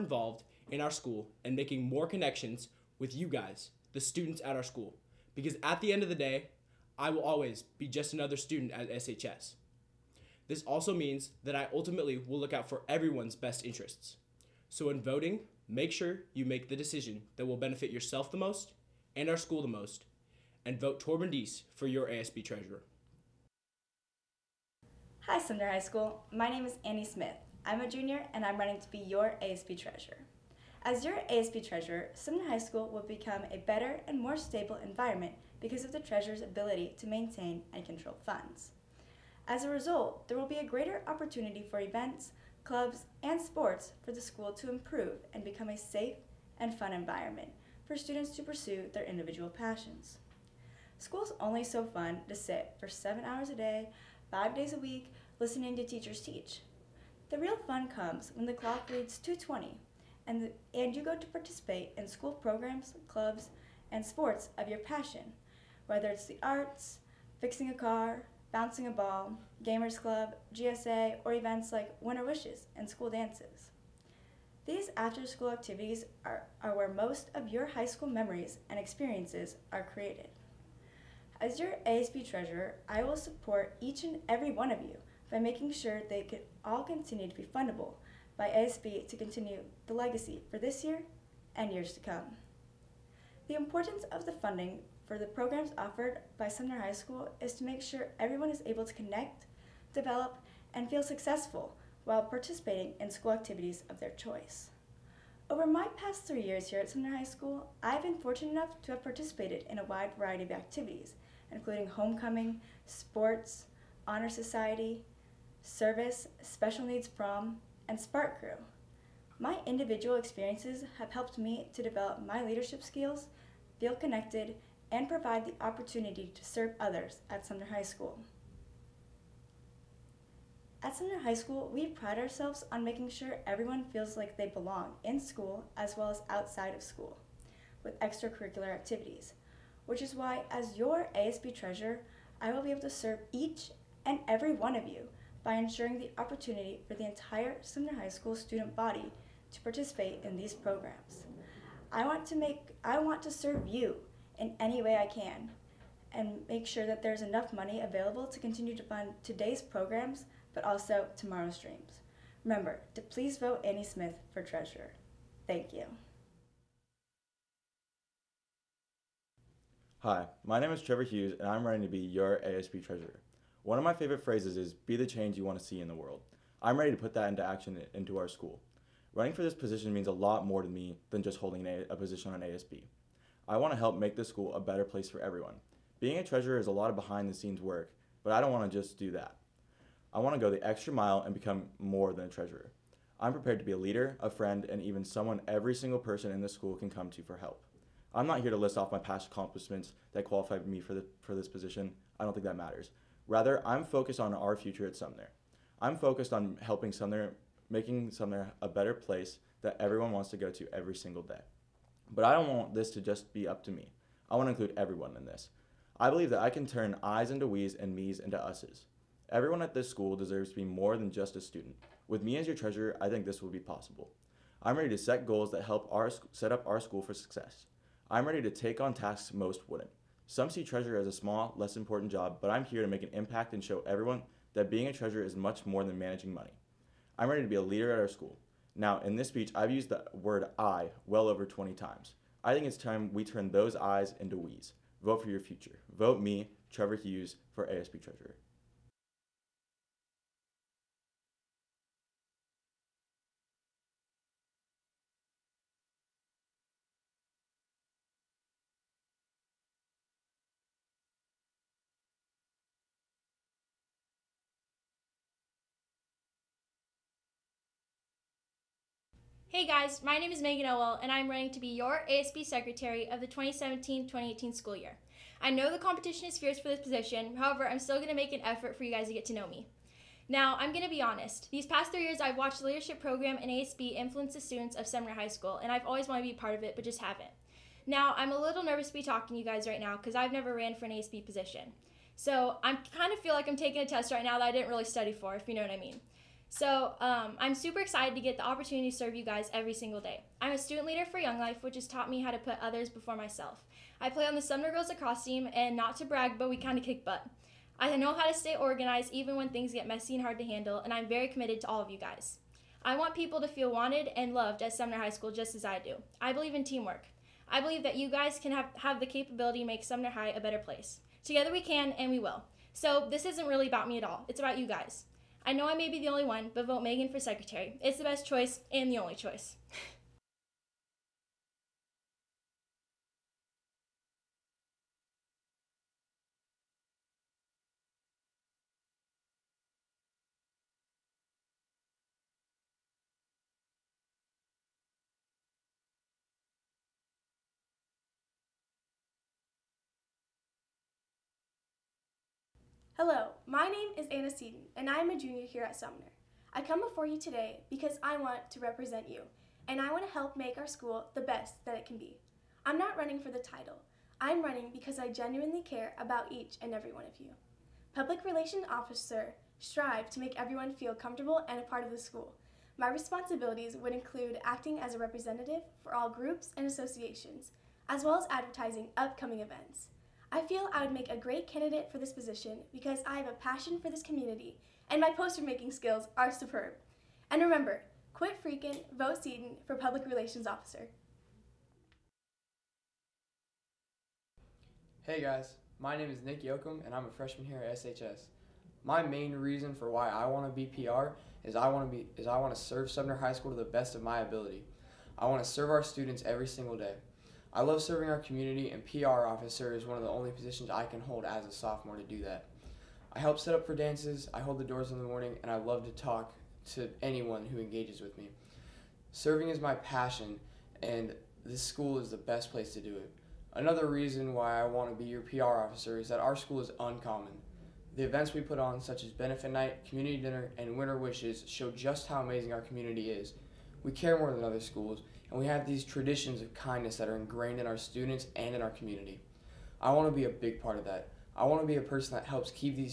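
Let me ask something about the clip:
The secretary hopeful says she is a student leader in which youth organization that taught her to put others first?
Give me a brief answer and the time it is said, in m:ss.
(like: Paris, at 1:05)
Young Life, at 5:01.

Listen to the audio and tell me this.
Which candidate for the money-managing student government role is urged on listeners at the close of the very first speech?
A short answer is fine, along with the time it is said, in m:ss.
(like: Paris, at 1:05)
Torben Dees, at 0:21.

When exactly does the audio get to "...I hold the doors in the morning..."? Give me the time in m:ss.
6:54.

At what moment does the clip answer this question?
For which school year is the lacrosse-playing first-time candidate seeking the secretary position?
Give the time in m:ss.
4:33.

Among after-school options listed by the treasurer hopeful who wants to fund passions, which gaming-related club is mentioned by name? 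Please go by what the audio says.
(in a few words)
Gamers Club.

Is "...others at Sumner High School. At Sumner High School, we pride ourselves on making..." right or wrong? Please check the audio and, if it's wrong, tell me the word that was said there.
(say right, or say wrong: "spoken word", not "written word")
right.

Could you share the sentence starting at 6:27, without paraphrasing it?
And remember, quit freaking, vote Seaton for Public Relations Officer.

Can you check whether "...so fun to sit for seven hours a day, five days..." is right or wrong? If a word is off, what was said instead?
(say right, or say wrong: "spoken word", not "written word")
right.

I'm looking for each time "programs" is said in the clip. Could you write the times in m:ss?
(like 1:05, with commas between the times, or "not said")
1:02, 1:35, 2:30, 2:39, 4:43.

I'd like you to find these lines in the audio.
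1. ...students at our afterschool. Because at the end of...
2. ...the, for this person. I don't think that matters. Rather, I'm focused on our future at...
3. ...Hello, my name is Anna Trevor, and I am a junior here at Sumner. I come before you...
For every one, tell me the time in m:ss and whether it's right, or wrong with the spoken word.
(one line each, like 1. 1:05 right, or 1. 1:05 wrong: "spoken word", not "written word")
1. 0:04 wrong: "school", not "afterschool"
2. 3:20 wrong: "position", not "person"
3. 5:53 wrong: "Seaton", not "Trevor".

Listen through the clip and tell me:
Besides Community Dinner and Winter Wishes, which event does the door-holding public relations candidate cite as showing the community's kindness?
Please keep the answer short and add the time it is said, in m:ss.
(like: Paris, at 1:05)
Benefit Night, at 7:09.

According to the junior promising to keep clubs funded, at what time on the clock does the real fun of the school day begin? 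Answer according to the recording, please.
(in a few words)
2:20.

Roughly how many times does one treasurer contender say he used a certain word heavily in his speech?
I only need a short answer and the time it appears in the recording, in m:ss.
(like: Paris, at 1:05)
over 20, at 4:01.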